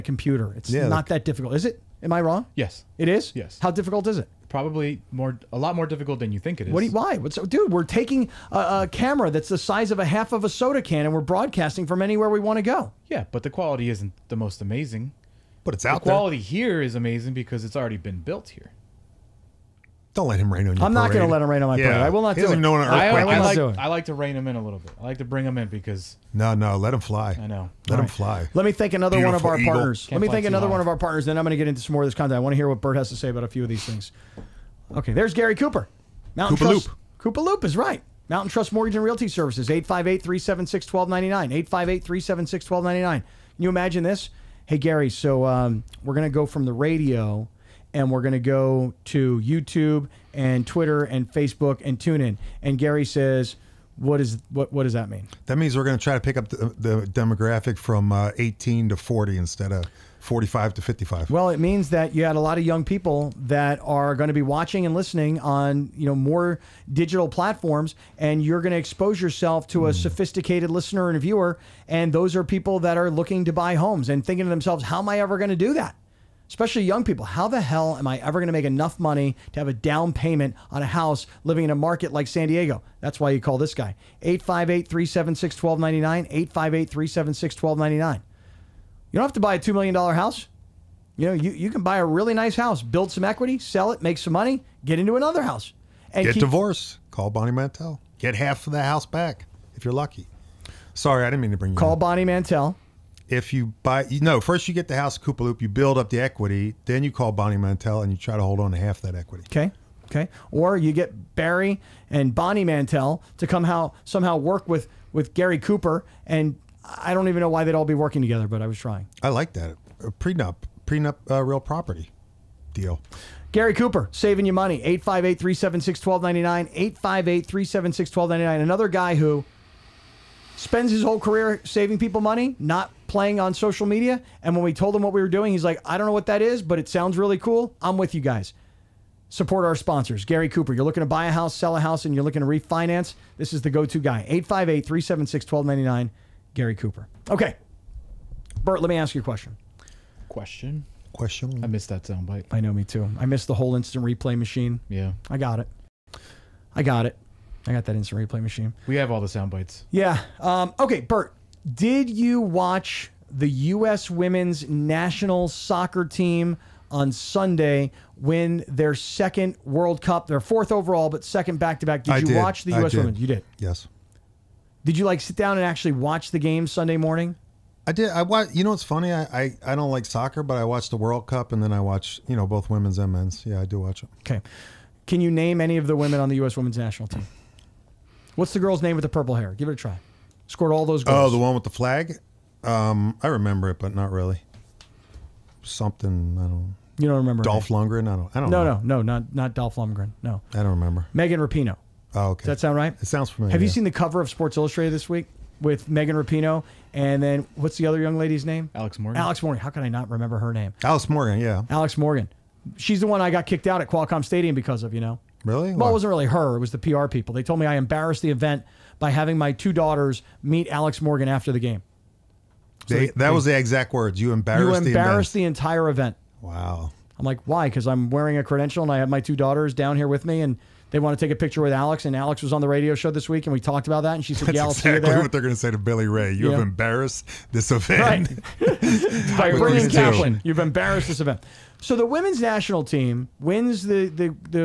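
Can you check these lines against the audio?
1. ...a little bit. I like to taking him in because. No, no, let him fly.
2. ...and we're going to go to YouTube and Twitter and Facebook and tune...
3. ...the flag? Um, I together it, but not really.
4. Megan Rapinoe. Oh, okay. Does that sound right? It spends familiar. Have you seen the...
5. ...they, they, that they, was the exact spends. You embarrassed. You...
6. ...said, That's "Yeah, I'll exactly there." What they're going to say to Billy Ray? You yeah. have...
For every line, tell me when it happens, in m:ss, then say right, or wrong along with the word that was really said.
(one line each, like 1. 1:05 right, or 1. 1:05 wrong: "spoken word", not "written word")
1. 0:24 wrong: "bring", not "taking"
2. 0:47 right
3. 3:11 wrong: "remember", not "together"
4. 3:21 wrong: "sounds", not "spends"
5. 3:42 wrong: "words", not "spends"
6. 3:54 right.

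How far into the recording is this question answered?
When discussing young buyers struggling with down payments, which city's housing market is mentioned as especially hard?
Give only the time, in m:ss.
1:22.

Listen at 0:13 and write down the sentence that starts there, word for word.
Yeah, but the quality isn't the most amazing.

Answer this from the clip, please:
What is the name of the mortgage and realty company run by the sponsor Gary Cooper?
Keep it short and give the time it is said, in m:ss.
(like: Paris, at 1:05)
Mountain Trust Mortgage and Realty Services, at 0:38.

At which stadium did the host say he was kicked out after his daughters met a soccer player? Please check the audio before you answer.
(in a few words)
Qualcomm Stadium.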